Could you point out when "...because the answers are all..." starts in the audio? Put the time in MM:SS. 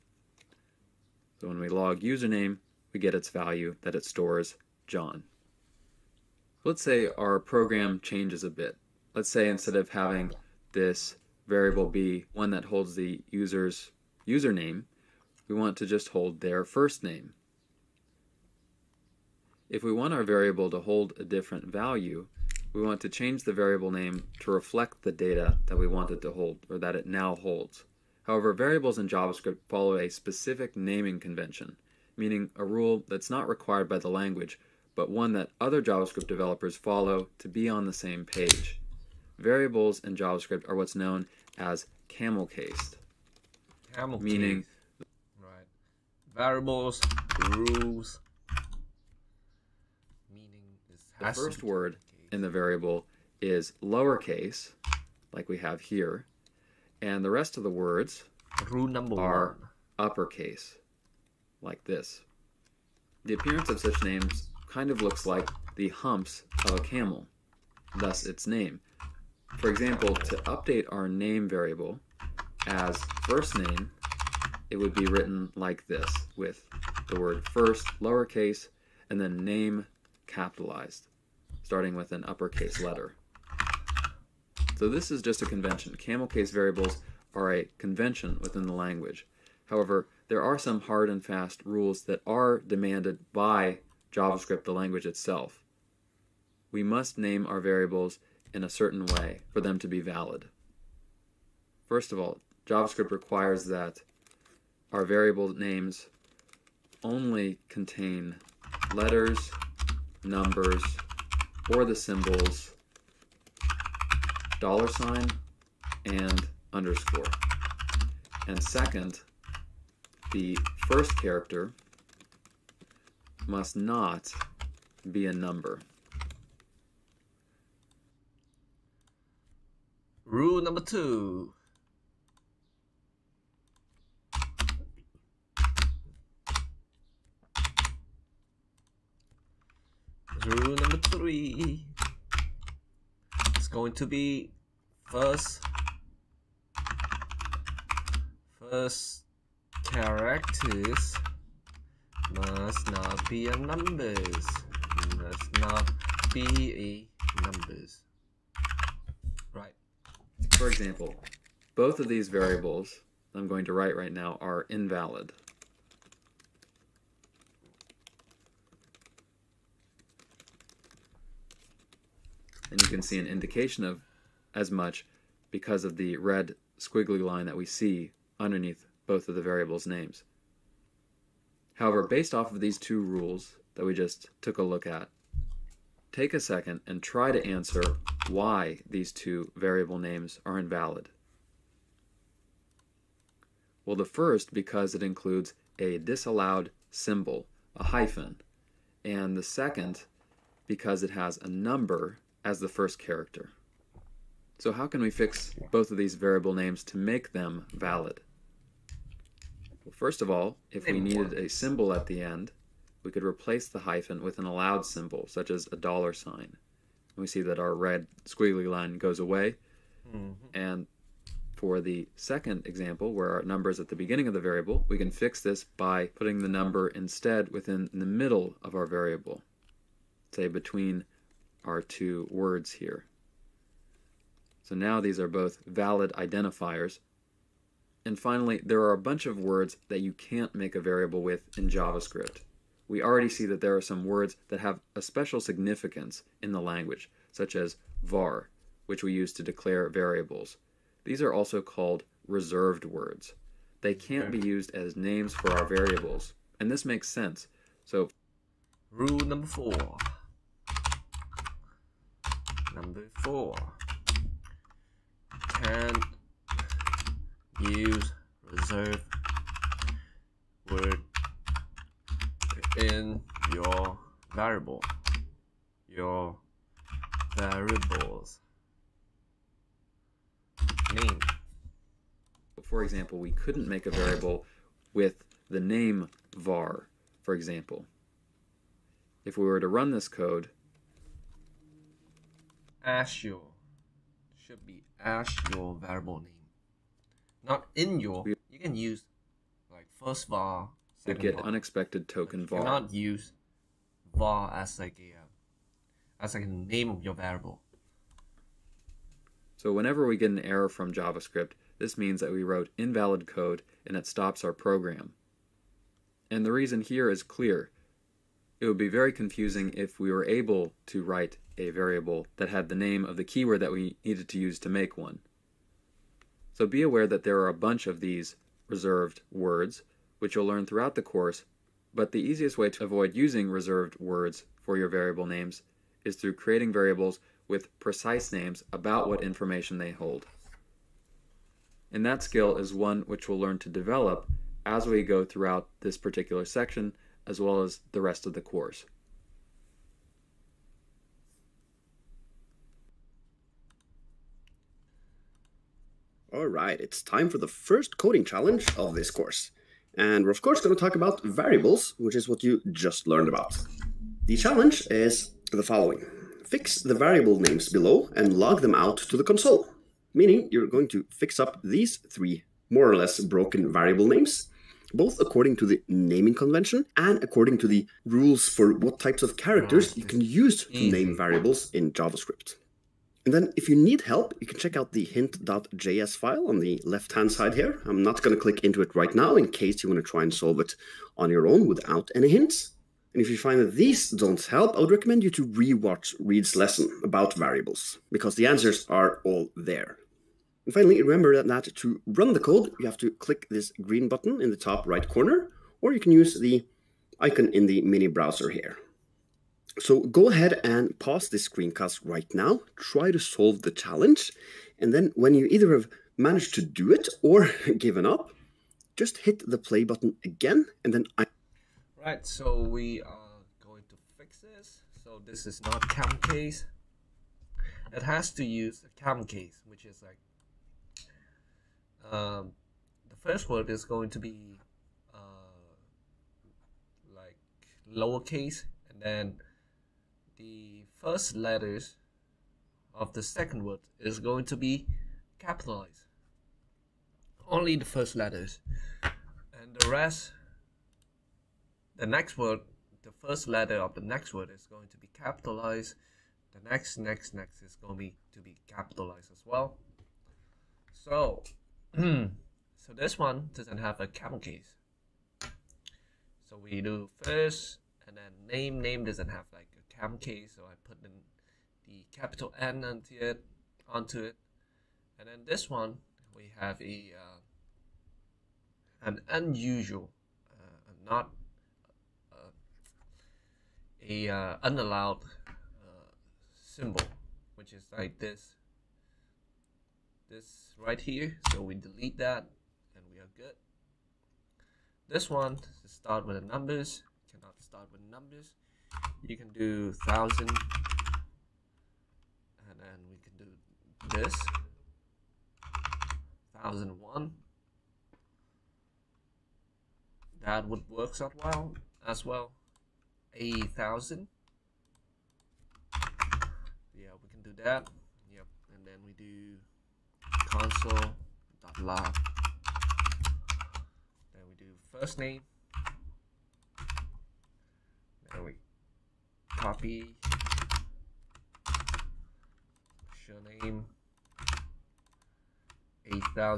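06:38.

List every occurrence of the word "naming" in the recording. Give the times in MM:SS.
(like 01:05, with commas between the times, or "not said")
00:30, 06:15.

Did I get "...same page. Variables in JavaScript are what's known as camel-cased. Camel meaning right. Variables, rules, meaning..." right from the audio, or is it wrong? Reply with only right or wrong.
right.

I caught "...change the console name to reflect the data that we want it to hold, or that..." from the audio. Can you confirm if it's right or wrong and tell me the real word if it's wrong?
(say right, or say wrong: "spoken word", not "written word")
wrong: "variable", not "console".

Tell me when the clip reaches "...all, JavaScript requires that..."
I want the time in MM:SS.
01:42.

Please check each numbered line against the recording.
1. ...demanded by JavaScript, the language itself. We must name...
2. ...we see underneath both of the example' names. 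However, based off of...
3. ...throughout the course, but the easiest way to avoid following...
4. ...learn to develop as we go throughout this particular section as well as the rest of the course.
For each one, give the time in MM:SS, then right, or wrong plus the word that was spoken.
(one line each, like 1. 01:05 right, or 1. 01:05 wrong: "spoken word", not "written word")
1. 01:32 right
2. 02:57 wrong: "variables", not "example"
3. 05:30 wrong: "using", not "following"
4. 05:43 right.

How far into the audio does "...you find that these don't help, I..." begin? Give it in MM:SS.
06:33.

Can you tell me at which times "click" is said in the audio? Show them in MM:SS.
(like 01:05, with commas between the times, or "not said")
06:28, 06:43.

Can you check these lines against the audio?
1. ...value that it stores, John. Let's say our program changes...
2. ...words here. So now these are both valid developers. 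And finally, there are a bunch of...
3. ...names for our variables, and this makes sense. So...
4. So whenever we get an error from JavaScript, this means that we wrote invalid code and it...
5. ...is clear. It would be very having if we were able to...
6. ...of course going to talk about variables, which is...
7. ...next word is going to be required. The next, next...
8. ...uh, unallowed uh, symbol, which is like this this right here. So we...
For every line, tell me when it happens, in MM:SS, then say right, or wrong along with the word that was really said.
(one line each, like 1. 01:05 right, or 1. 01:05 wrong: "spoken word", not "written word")
1. 00:03 right
2. 03:52 wrong: "identifiers", not "developers"
3. 04:14 right
4. 05:09 right
5. 05:17 wrong: "confusing", not "having"
6. 06:00 right
7. 07:34 wrong: "capitalized", not "required"
8. 08:04 right.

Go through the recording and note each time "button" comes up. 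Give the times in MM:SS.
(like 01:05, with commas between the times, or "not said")
06:44, 06:59.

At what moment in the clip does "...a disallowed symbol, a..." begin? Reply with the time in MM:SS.
03:15.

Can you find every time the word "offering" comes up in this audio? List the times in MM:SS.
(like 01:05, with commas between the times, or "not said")
not said.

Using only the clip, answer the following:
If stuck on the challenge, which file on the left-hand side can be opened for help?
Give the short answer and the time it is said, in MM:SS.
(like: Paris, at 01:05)
hint.js, at 06:25.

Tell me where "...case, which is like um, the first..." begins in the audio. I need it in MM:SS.
07:09.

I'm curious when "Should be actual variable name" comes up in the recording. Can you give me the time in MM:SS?
04:54.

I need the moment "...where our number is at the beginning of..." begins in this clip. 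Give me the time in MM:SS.
03:43.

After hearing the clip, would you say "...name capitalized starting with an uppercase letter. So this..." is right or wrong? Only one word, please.
right.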